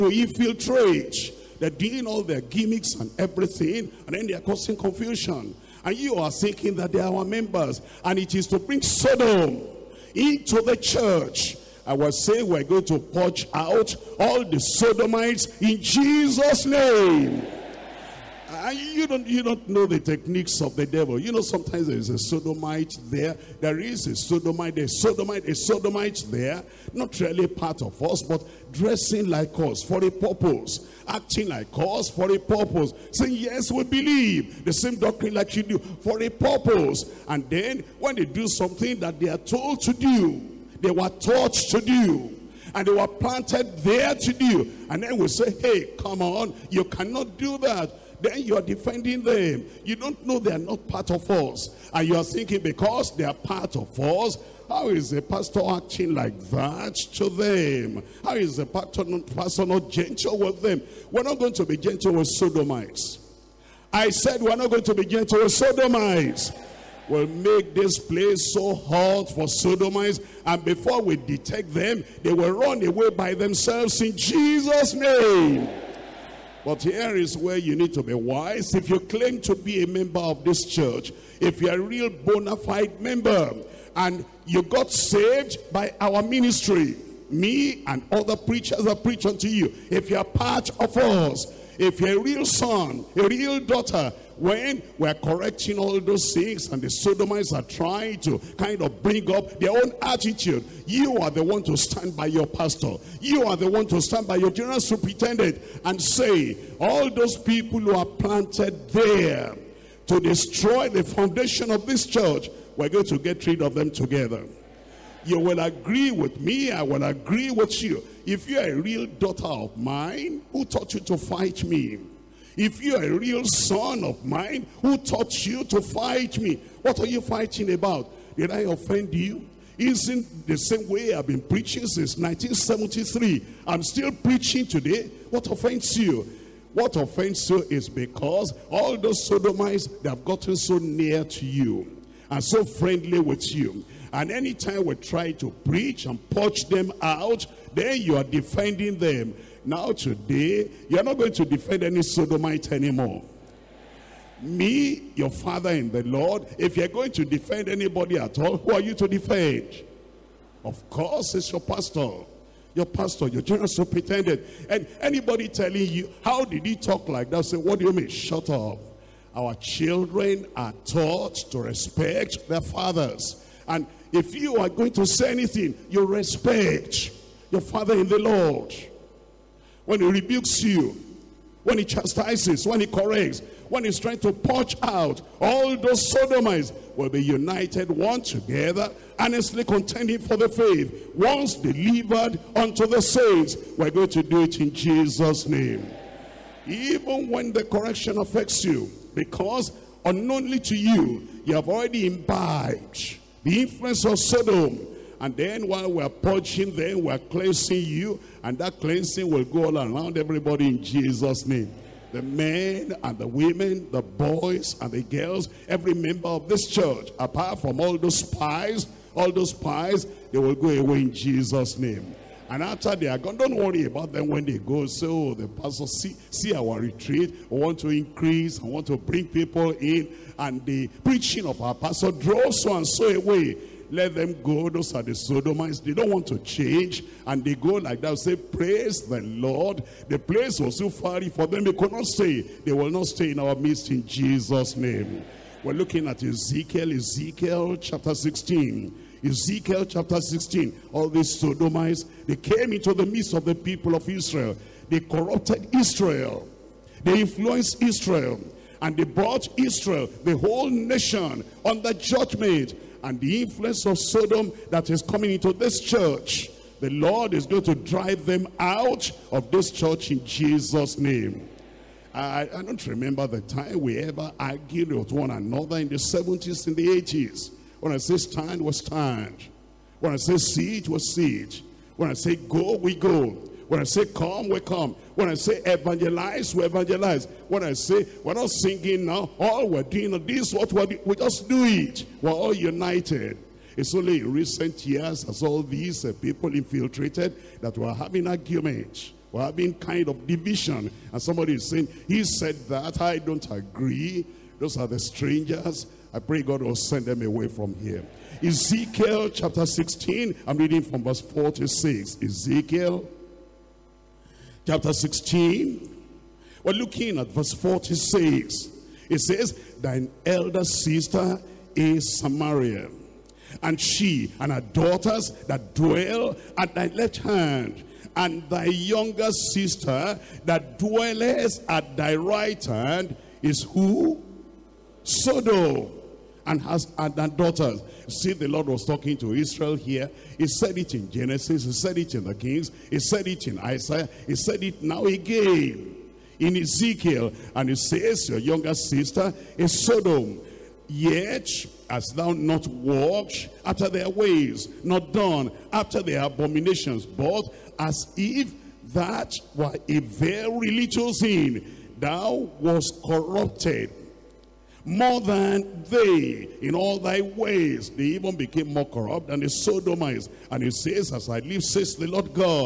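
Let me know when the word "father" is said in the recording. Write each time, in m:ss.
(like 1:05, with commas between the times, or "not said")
2:35, 2:52, 2:57.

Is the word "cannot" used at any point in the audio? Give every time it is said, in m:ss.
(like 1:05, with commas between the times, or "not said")
0:46.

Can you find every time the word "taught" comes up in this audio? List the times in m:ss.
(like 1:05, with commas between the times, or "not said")
0:41, 2:00, 2:04, 2:50.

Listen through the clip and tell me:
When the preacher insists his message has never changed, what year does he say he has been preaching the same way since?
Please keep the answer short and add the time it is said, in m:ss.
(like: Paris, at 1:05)
1973, at 2:12.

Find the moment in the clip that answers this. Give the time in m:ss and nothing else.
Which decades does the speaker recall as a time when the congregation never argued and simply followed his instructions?
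4:35.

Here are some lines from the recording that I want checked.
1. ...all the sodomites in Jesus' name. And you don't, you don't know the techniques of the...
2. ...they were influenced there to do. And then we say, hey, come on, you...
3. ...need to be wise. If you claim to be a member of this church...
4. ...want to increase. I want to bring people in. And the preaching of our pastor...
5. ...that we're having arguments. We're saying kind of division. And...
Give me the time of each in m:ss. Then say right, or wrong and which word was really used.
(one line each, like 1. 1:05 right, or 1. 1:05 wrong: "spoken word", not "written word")
1. 0:14 right
2. 0:42 wrong: "planted", not "influenced"
3. 1:17 right
4. 3:47 right
5. 4:57 wrong: "having", not "saying".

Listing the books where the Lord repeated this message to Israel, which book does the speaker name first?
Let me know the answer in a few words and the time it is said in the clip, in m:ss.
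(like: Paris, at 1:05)
Genesis, at 5:41.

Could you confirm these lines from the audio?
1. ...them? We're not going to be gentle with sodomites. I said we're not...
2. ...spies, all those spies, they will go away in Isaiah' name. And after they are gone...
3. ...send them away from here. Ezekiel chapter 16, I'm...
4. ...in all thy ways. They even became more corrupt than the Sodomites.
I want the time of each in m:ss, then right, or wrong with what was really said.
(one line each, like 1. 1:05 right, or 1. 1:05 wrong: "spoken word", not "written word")
1. 1:00 right
2. 3:38 wrong: "Jesus", not "Isaiah"
3. 5:06 right
4. 6:06 right.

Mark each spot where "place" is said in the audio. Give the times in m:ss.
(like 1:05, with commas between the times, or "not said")
1:07, 4:00.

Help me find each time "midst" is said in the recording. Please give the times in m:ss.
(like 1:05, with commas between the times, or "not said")
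4:03, 4:13.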